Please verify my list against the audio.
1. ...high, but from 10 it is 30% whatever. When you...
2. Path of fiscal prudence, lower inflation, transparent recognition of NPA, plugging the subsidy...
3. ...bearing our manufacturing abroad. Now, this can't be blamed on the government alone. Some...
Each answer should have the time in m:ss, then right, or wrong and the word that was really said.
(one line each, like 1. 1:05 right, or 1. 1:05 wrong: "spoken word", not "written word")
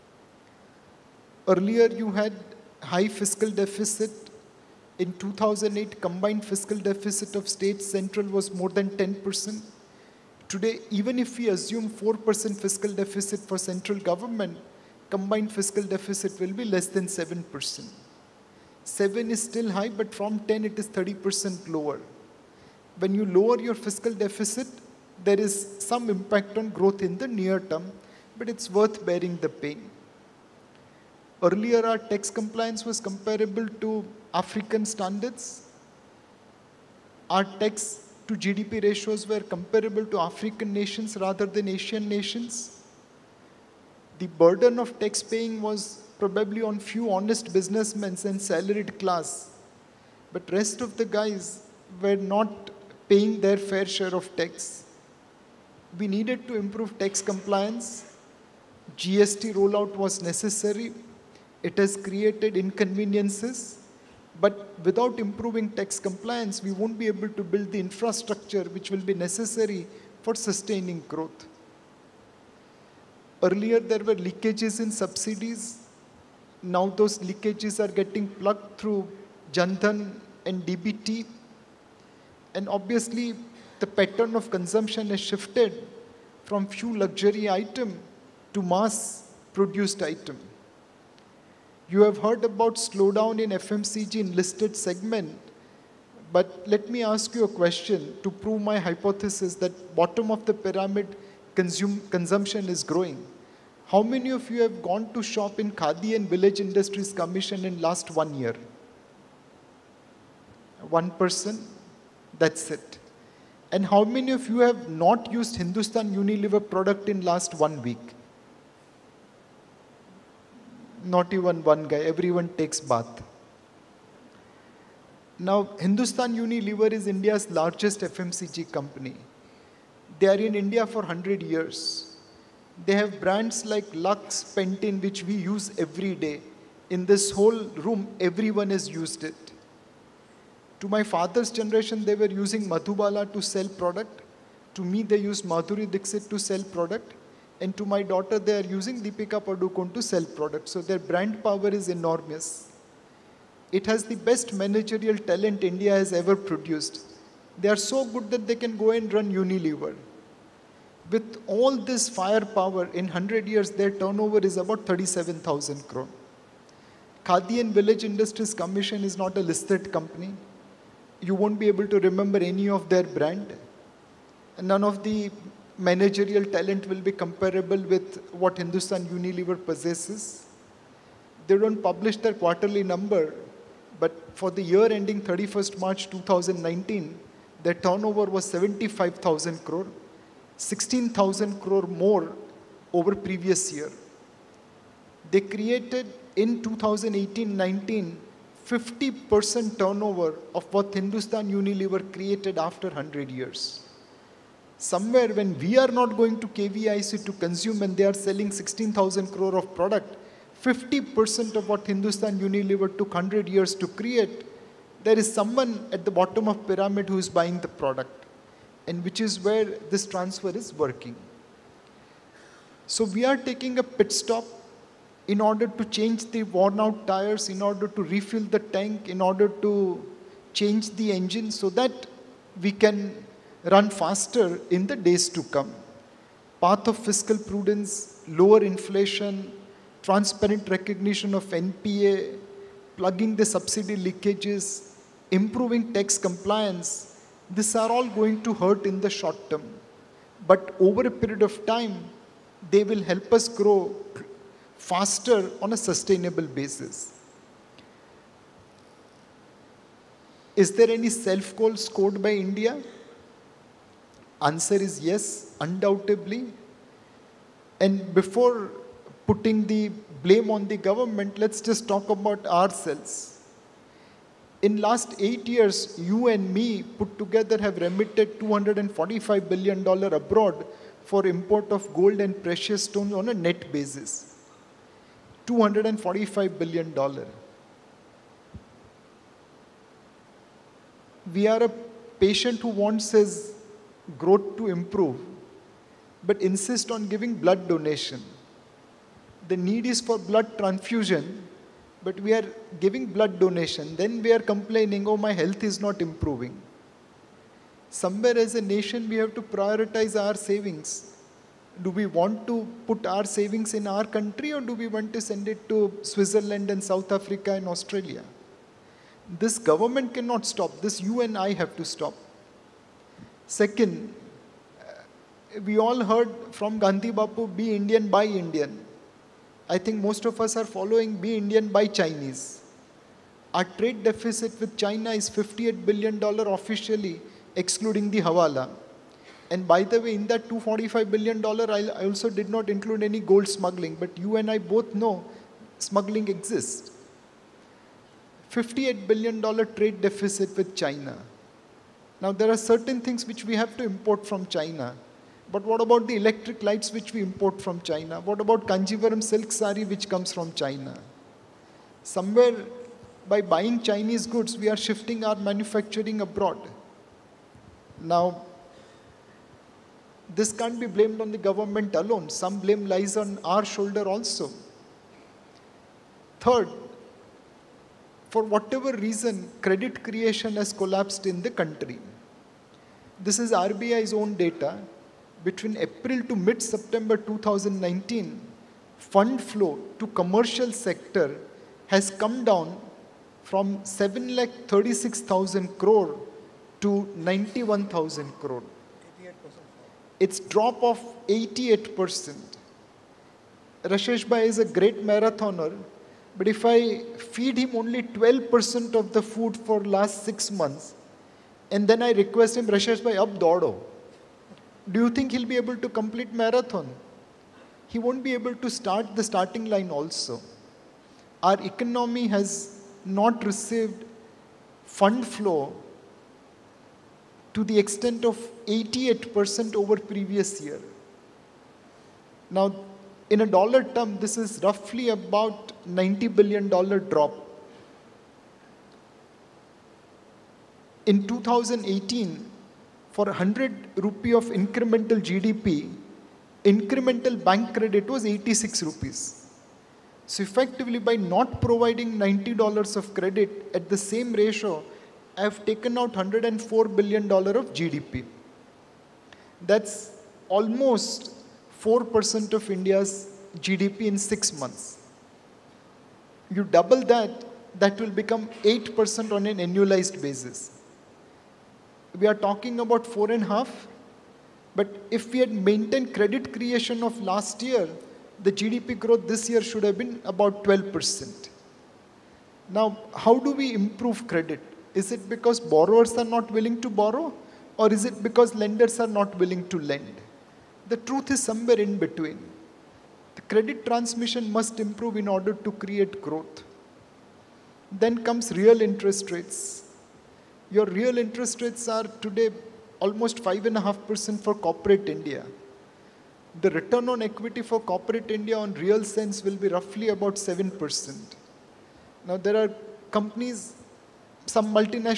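1. 0:19 wrong: "lower", not "whatever"
2. 3:56 right
3. 6:04 wrong: "shifting", not "bearing".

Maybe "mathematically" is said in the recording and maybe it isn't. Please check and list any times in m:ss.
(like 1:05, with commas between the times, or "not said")
not said.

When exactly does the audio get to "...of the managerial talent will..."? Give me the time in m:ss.
2:54.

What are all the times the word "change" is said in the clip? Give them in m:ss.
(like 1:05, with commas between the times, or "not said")
3:45, 3:50.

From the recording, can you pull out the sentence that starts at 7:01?
Our economy has not received fund flow to the extent of 88% over previous year.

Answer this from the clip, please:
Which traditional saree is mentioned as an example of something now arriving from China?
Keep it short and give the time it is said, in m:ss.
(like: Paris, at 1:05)
Kanjivaram silk sari, at 5:58.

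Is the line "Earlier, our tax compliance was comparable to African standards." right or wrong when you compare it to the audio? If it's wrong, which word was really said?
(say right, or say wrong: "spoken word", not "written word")
right.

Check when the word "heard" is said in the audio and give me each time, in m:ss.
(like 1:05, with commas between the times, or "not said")
1:32, 5:26.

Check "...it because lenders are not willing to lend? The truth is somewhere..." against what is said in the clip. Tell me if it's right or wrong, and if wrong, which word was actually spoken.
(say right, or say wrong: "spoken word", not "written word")
right.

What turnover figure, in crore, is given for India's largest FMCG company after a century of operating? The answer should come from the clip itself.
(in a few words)
37,000 crore.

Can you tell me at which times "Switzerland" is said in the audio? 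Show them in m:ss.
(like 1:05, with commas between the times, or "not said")
5:16.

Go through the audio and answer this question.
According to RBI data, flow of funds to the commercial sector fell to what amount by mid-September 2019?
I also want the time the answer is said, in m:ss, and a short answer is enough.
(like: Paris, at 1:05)
91,000 crore, at 6:37.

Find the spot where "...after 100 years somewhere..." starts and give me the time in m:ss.
3:22.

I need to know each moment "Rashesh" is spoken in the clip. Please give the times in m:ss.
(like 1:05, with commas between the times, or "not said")
6:43, 6:52.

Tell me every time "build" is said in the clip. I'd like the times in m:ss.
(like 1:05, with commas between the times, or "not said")
1:07.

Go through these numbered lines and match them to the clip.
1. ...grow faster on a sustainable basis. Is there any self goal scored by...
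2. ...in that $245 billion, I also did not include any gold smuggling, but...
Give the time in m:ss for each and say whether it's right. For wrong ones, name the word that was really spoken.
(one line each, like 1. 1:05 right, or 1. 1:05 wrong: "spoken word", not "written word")
1. 4:13 right
2. 5:40 right.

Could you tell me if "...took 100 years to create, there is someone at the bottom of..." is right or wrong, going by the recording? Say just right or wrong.
right.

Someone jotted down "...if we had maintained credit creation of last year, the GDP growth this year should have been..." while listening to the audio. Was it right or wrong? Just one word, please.
right.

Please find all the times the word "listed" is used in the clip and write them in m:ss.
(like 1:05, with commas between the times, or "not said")
1:34, 2:49.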